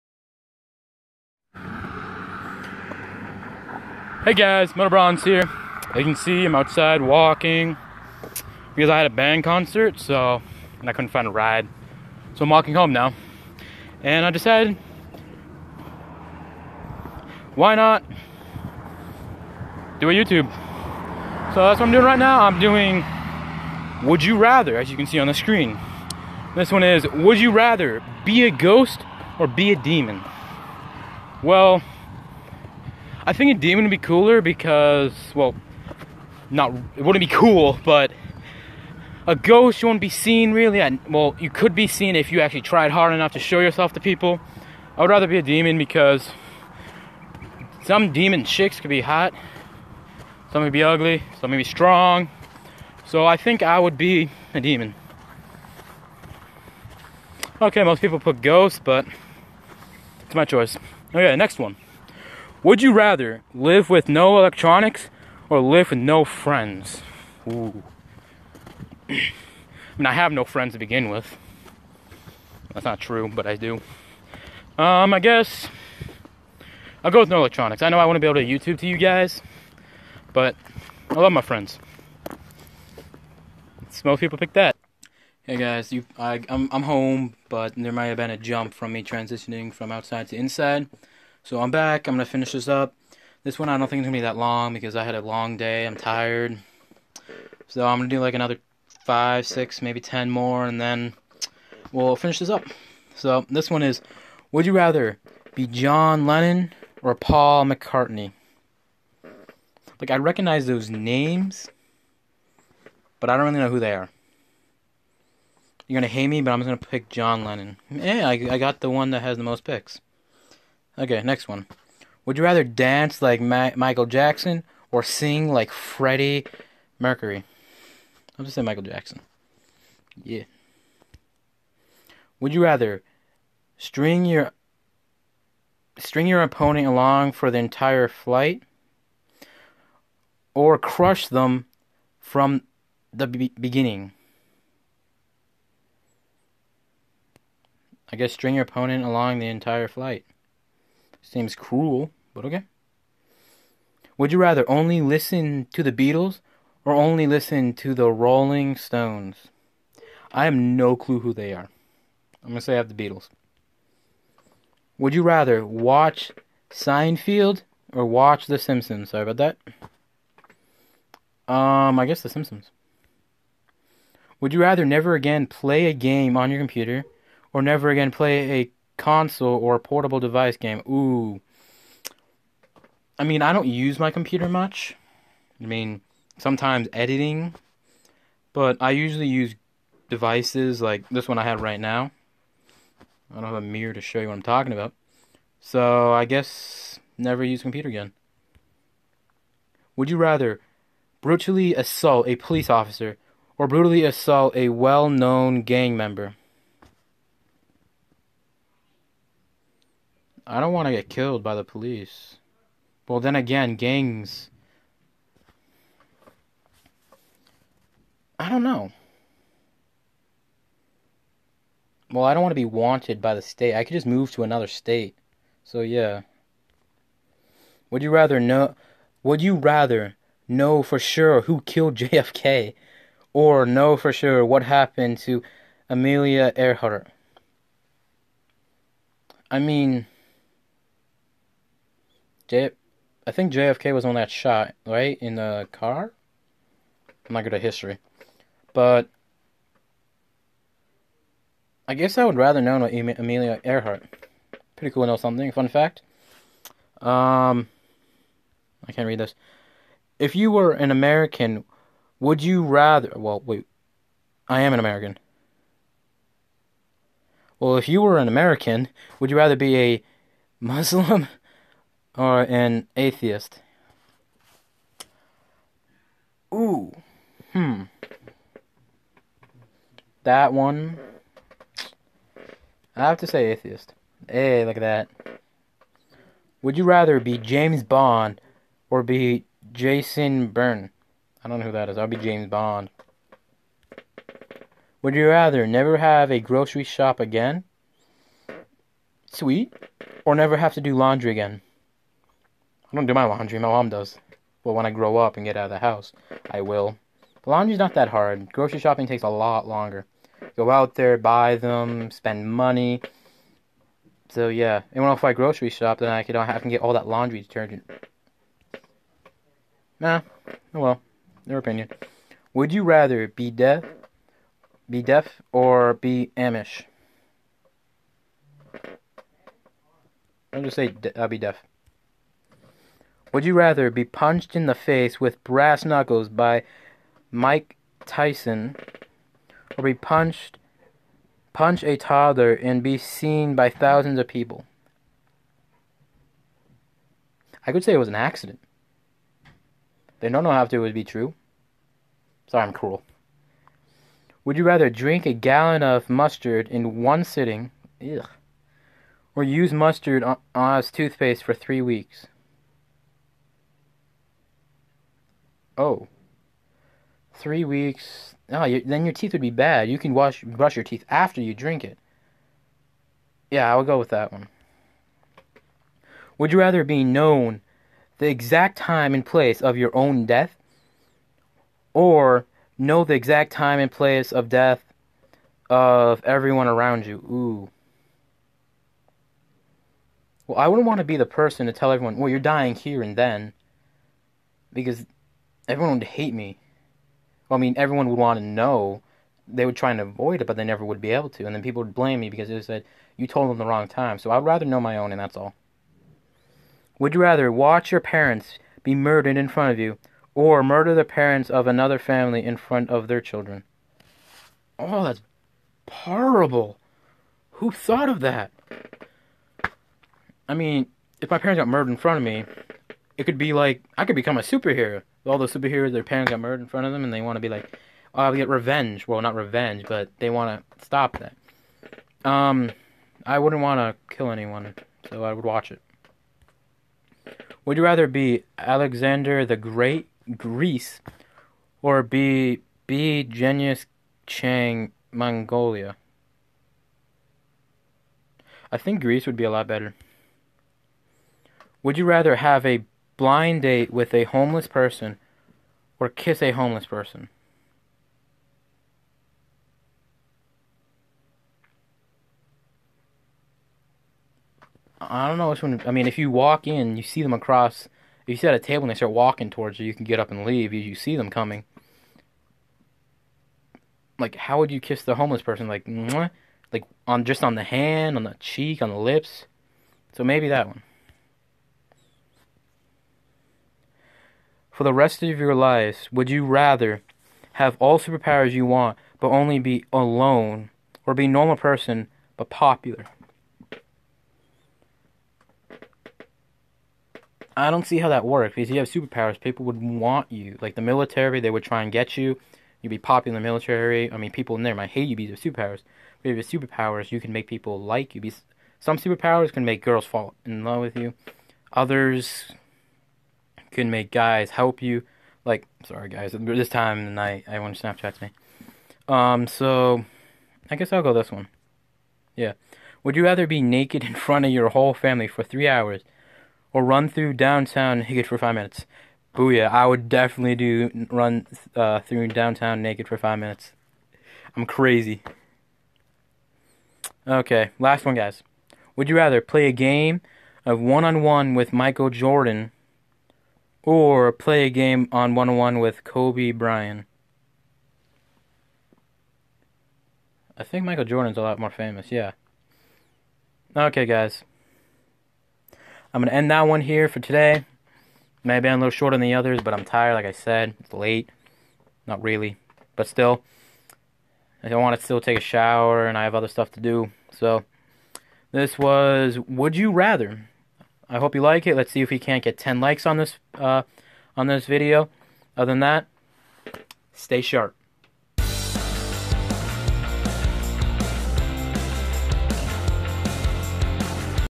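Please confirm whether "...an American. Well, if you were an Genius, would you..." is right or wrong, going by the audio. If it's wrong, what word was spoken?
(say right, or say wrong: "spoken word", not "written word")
wrong: "American", not "Genius".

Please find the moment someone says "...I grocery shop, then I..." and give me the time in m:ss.
5:15.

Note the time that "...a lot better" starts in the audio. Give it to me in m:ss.
7:29.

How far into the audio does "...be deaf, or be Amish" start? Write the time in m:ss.
5:24.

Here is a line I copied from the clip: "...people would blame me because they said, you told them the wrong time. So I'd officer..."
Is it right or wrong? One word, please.
wrong.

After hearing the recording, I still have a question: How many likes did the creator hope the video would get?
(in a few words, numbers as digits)
10.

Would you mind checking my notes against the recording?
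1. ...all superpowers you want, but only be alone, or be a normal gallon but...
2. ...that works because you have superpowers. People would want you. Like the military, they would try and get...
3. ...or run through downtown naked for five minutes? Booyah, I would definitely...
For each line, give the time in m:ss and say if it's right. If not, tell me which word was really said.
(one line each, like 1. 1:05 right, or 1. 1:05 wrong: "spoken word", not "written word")
1. 8:07 wrong: "person", not "gallon"
2. 8:18 right
3. 8:46 right.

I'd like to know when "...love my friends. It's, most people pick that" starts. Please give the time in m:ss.
1:21.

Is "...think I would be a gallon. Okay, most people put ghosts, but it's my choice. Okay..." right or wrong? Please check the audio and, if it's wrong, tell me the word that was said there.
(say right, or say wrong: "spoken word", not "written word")
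wrong: "demon", not "gallon".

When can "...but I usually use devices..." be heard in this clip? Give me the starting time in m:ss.
3:08.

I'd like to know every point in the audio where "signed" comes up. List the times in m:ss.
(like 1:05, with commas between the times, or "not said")
not said.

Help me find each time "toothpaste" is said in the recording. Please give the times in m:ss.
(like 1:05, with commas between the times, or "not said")
6:00.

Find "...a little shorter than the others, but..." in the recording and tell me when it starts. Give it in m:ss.
9:18.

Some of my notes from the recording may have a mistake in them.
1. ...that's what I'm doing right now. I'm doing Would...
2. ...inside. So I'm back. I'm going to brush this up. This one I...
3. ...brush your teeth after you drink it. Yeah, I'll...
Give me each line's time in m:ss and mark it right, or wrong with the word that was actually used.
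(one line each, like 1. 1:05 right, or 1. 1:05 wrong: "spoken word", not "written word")
1. 0:21 right
2. 1:30 wrong: "finish", not "brush"
3. 6:10 right.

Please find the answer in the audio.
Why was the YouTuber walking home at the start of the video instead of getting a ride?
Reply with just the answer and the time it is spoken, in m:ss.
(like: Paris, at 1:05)
Band concert, at 0:09.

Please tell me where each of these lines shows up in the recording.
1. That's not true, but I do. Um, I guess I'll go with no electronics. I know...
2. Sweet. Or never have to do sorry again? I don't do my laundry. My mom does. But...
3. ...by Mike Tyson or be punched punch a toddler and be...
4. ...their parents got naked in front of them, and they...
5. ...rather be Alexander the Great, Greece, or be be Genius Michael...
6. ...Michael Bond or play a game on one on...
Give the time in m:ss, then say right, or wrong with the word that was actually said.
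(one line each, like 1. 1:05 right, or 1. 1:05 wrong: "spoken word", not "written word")
1. 1:12 right
2. 4:59 wrong: "laundry", not "sorry"
3. 5:36 right
4. 7:05 wrong: "murdered", not "naked"
5. 7:17 wrong: "Chang", not "Michael"
6. 9:01 wrong: "Jordan", not "Bond".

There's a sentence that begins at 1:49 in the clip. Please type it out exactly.
Like, I recognize those names, but I don't really know who they are.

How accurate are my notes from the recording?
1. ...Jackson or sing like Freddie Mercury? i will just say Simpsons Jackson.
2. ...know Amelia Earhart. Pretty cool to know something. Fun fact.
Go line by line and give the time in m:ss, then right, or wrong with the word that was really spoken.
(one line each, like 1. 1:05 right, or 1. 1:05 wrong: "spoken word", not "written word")
1. 2:04 wrong: "Michael", not "Simpsons"
2. 4:12 right.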